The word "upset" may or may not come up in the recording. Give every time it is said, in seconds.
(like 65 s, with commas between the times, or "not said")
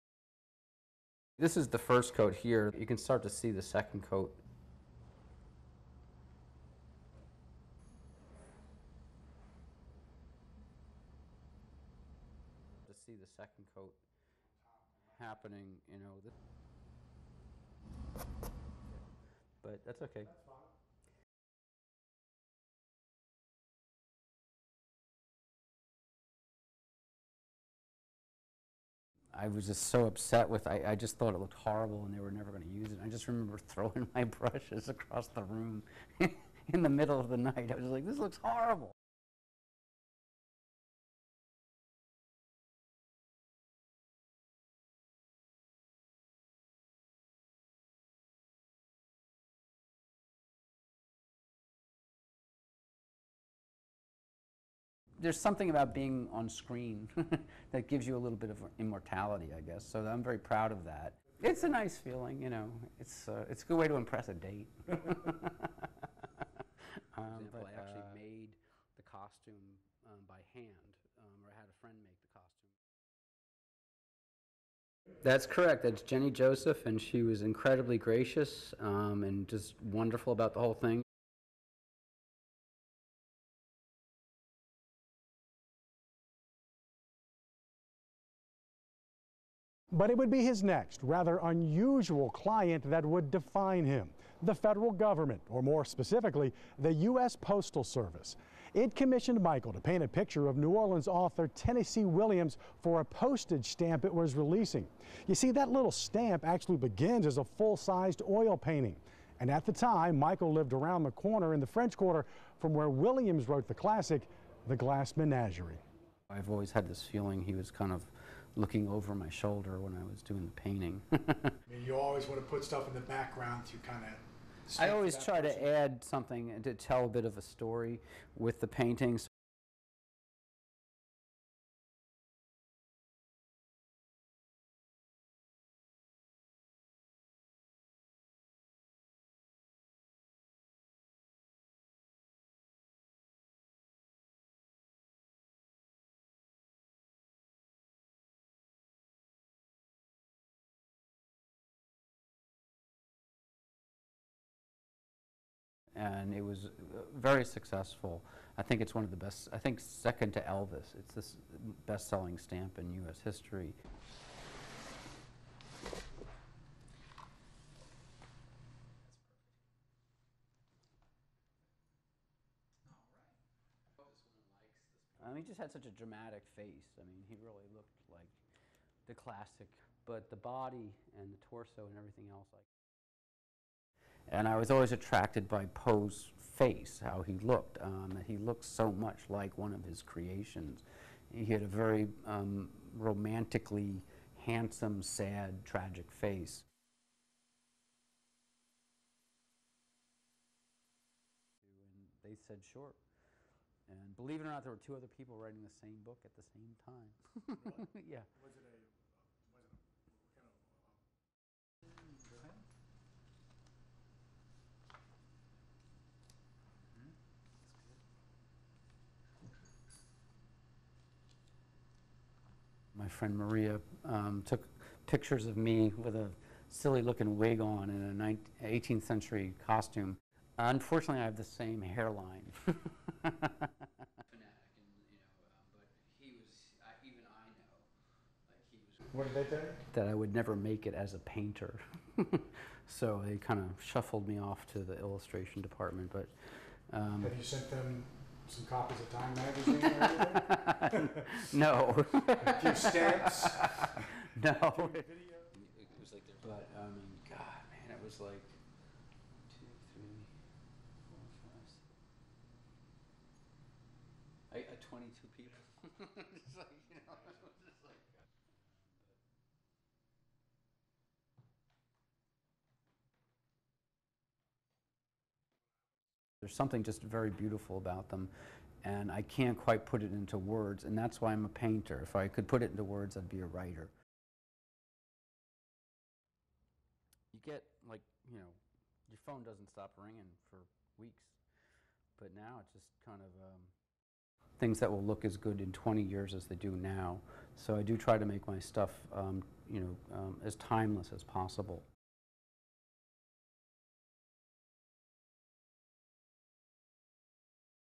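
30 s.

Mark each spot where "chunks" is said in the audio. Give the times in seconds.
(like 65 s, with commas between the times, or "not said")
not said.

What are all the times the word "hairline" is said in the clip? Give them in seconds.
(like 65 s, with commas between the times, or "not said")
231 s.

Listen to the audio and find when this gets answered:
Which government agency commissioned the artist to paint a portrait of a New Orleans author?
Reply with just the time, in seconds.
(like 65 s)
96 s.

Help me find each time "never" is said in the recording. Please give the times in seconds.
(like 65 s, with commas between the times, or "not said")
32 s, 240 s.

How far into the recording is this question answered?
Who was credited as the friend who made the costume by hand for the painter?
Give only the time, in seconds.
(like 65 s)
76 s.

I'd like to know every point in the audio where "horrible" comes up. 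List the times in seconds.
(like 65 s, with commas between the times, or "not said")
31 s, 38 s.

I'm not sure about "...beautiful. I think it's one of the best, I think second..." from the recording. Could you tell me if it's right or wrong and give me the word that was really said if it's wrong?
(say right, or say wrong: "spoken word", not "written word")
wrong: "successful", not "beautiful".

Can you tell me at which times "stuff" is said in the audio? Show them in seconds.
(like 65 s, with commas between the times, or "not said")
122 s, 298 s.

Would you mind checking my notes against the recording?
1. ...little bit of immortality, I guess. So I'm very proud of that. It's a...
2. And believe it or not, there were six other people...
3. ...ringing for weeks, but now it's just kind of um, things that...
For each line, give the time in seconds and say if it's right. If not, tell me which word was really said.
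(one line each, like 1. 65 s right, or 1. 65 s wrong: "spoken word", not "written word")
1. 58 s right
2. 203 s wrong: "two", not "six"
3. 289 s right.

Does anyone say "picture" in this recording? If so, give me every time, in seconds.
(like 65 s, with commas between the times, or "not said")
100 s, 225 s.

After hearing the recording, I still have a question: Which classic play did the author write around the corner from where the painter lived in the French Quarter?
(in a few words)
The Glass Menagerie.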